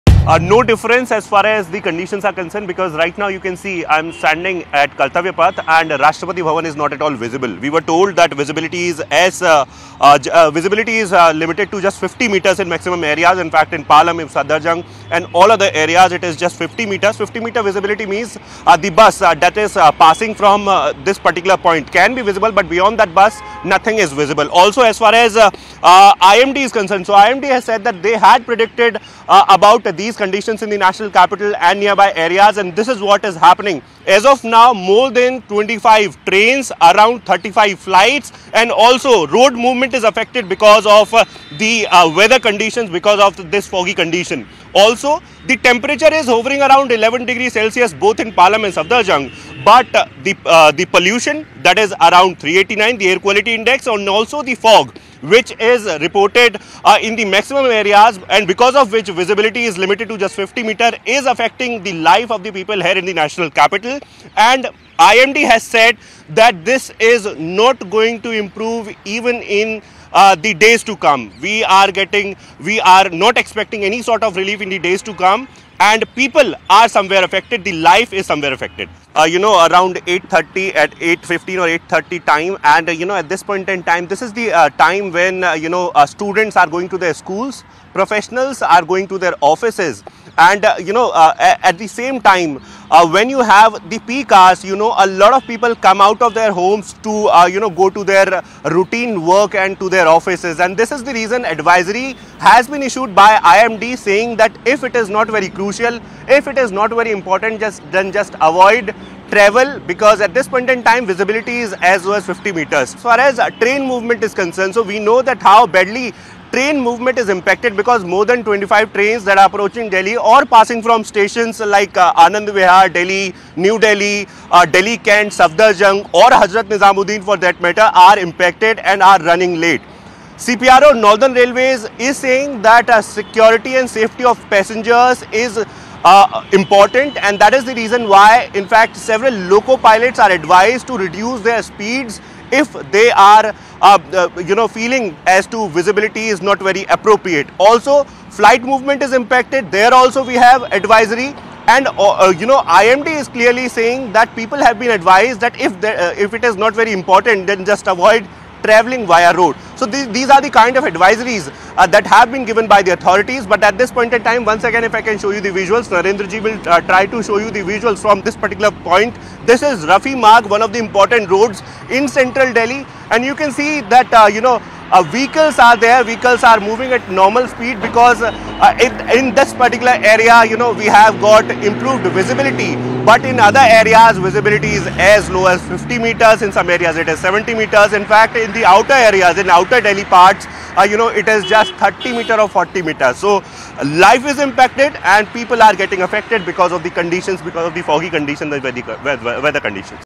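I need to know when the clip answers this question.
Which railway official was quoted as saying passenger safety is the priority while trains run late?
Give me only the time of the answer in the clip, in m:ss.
2:10.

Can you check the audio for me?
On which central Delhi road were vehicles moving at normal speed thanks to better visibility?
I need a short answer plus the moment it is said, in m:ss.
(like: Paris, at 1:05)
Rafi Marg, at 2:49.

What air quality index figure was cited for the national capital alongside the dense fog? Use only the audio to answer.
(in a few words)
389.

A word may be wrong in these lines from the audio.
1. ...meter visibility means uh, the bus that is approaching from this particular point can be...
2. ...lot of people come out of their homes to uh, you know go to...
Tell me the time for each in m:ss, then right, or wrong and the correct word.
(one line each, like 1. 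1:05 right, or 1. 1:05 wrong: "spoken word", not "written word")
1. 0:17 wrong: "passing", not "approaching"
2. 1:35 right.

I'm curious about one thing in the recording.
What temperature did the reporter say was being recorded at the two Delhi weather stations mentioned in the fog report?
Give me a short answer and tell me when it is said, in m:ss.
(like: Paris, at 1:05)
11 degrees Celsius, at 0:46.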